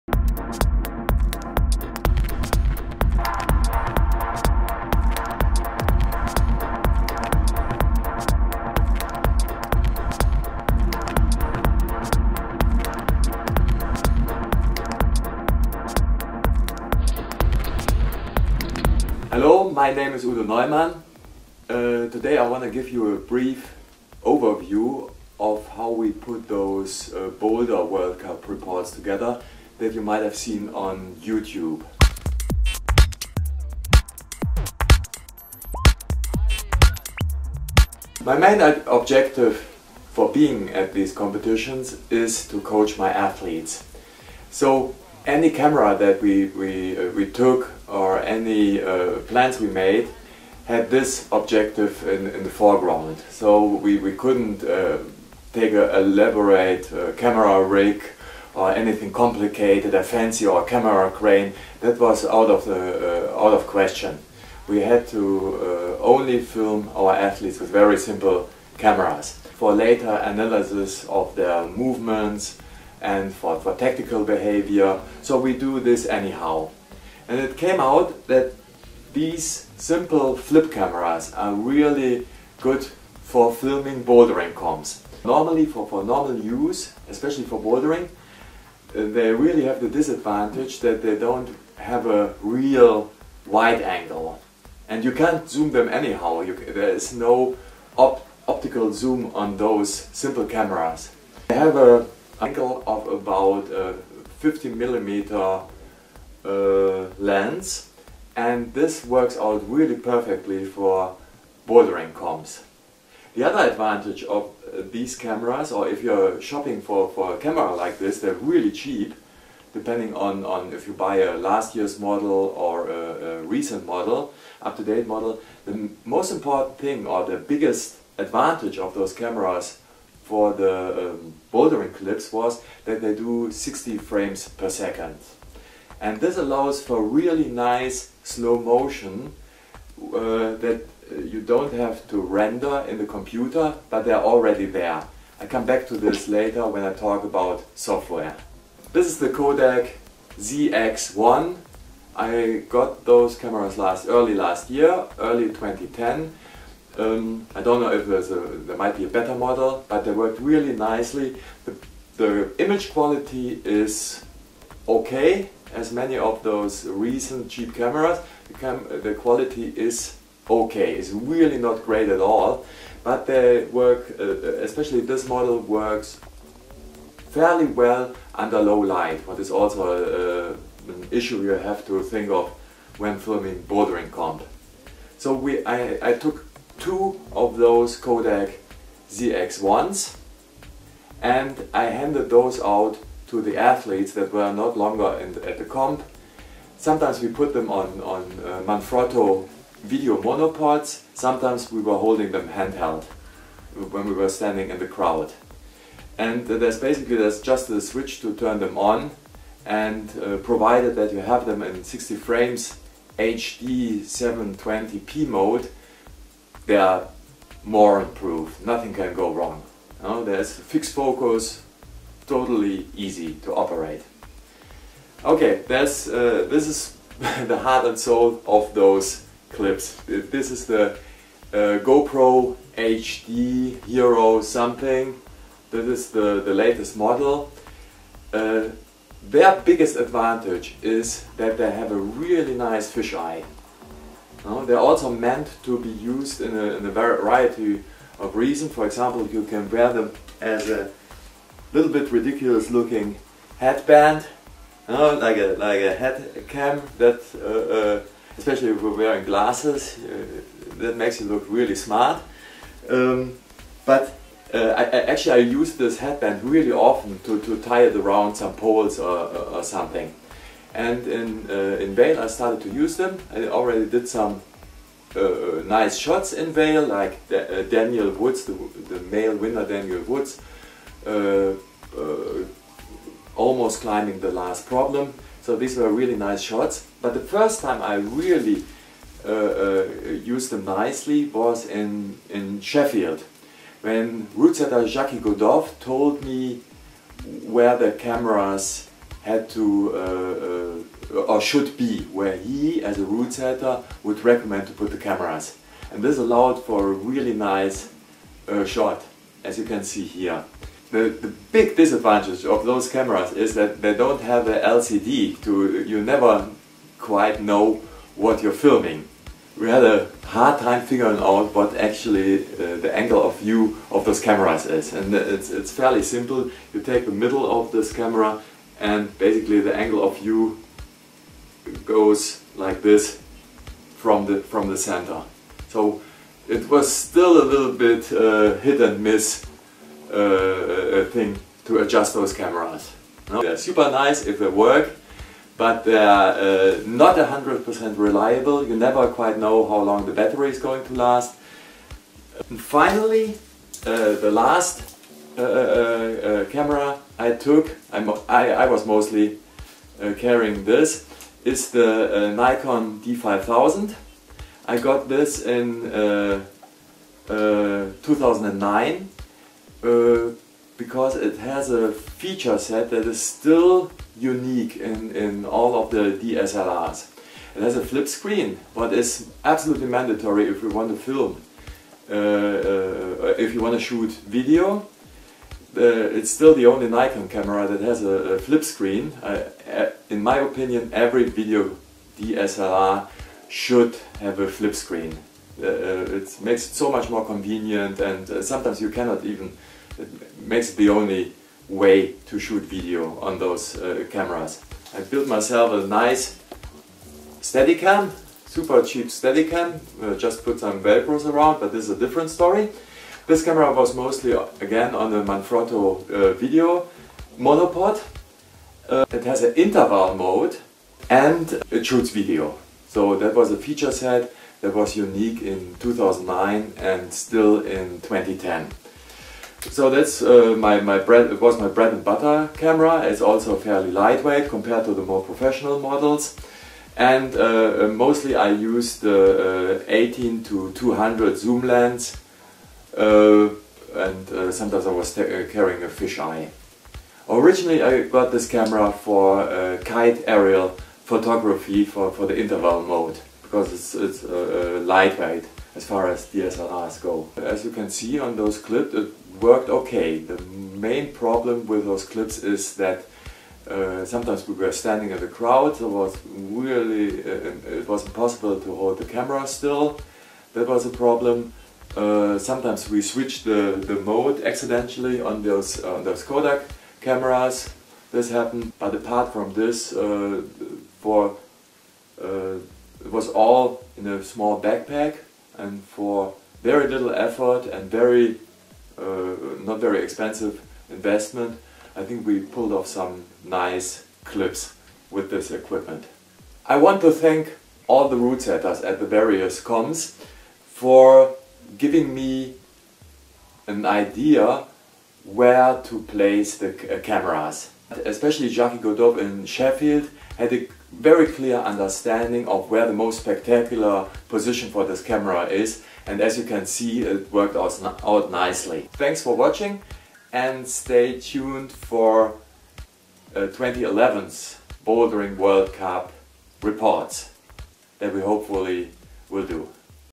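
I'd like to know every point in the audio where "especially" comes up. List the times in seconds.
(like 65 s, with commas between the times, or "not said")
87 s, 174 s, 258 s, 508 s.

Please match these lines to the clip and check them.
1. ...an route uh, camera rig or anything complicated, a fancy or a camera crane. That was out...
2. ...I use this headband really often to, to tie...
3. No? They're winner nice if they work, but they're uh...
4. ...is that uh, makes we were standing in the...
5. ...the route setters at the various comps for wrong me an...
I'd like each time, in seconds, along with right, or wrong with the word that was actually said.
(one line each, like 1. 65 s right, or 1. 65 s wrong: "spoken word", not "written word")
1. 55 s wrong: "elaborate", not "route"
2. 265 s right
3. 343 s wrong: "super", not "winner"
4. 462 s wrong: "sometimes", not "makes"
5. 498 s wrong: "giving", not "wrong".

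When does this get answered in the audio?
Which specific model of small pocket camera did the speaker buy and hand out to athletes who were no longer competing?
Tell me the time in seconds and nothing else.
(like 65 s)
149 s.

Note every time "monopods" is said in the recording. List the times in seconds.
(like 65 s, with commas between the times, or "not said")
200 s, 417 s.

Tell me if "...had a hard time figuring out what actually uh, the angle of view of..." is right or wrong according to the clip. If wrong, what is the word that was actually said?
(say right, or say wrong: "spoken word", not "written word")
right.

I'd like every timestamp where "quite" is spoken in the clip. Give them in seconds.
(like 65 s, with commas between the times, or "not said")
316 s, 349 s.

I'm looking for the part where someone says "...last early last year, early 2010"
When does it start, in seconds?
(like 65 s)
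153 s.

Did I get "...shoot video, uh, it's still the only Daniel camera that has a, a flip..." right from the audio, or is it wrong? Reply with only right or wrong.
wrong.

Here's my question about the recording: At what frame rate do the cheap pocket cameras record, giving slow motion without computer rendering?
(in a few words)
60 frames per second.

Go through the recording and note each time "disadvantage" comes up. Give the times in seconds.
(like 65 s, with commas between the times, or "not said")
89 s, 311 s.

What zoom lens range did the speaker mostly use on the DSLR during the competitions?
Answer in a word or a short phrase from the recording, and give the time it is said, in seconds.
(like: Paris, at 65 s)
18 to 200, at 439 s.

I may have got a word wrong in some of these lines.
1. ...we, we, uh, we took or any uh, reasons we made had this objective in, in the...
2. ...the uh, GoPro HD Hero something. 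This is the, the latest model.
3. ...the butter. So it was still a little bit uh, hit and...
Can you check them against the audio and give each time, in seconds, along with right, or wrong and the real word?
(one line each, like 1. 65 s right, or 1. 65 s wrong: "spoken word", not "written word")
1. 46 s wrong: "plans", not "reasons"
2. 230 s right
3. 334 s wrong: "center", not "butter".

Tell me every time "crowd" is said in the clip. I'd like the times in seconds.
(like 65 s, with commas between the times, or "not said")
204 s, 465 s.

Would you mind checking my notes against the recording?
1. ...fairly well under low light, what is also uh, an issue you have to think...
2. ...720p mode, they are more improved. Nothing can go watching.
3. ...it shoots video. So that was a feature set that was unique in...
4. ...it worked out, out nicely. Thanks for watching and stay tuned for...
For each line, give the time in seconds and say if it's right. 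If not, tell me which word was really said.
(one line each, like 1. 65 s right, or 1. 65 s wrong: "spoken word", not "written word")
1. 177 s right
2. 214 s wrong: "wrong", not "watching"
3. 421 s right
4. 517 s right.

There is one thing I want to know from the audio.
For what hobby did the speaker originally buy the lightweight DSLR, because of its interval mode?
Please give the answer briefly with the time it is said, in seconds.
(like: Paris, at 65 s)
Kite aerial photography, at 449 s.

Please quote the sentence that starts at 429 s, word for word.
So that's uh, my, my bread, was my bread and butter camera.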